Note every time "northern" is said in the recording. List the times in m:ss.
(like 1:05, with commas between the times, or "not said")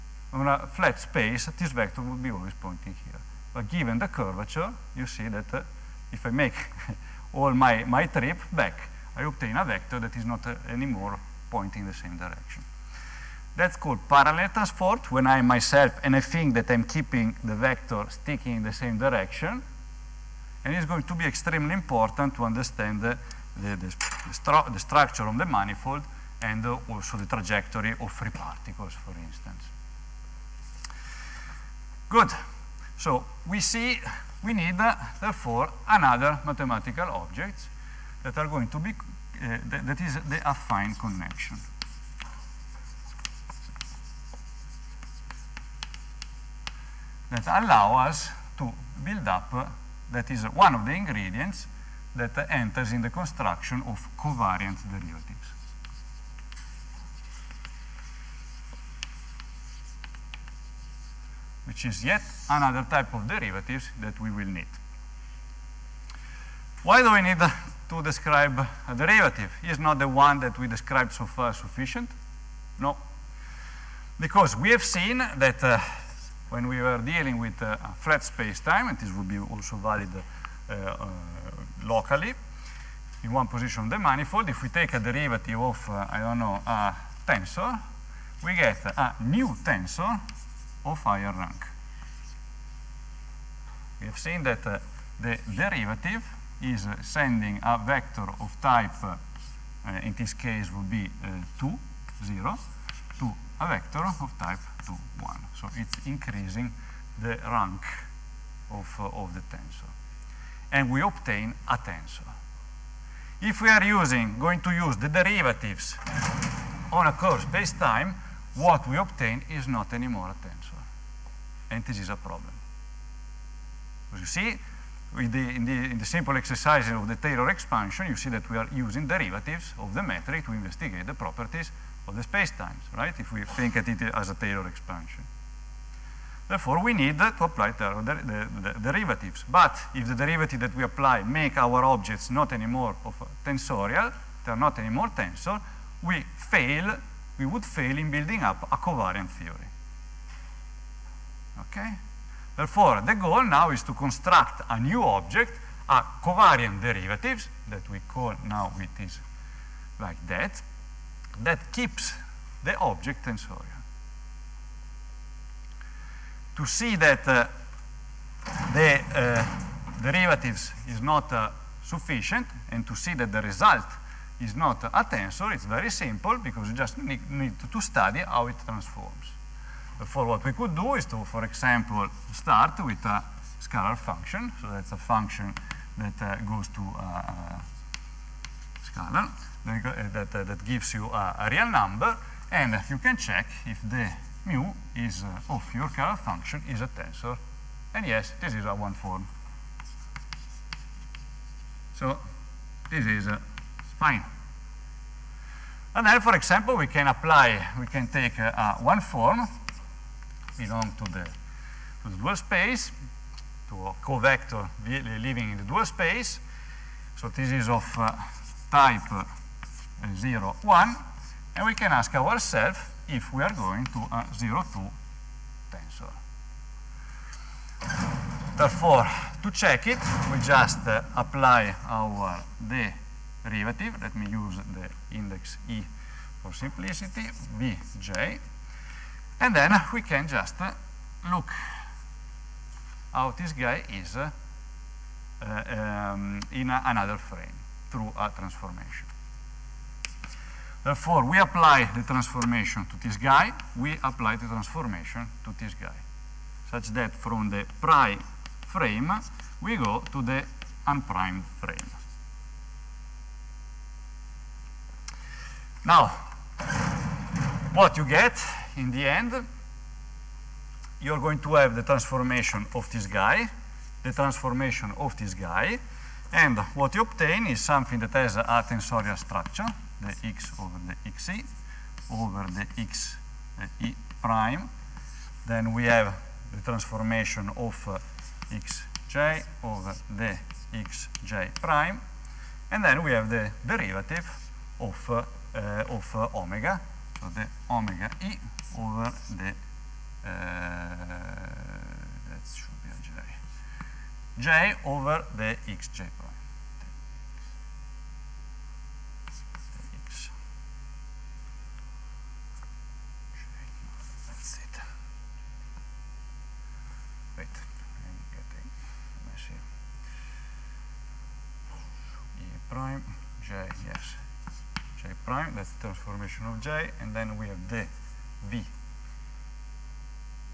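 not said.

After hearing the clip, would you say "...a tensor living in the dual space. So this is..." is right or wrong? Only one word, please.
wrong.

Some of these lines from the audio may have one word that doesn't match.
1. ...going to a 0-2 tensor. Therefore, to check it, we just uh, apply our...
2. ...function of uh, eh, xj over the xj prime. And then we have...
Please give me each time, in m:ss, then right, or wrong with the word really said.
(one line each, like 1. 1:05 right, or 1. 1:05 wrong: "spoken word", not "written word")
1. 3:43 right
2. 4:46 wrong: "transformation", not "function".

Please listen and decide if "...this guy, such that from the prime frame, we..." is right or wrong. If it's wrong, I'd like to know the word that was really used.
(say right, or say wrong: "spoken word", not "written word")
right.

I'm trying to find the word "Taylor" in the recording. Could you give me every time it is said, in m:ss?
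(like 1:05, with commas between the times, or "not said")
2:07, 2:14.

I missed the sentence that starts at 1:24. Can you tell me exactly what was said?
If we take a derivative of, uh, I don't know, a tensor, we get a new tensor of higher rank.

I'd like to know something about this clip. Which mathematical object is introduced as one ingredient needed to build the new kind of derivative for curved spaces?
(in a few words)
affine connection.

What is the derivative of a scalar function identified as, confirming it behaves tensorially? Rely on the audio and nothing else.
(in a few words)
a one form.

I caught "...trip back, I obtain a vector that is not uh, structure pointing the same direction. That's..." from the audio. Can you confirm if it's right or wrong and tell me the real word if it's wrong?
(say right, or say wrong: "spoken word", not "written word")
wrong: "anymore", not "structure".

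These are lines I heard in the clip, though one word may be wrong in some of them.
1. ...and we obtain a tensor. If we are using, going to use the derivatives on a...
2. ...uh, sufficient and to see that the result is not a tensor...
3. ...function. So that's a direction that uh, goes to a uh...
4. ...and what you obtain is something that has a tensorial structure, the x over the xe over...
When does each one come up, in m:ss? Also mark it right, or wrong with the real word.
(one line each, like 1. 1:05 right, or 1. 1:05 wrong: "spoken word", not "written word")
1. 1:50 right
2. 2:51 right
3. 3:03 wrong: "function", not "direction"
4. 4:36 right.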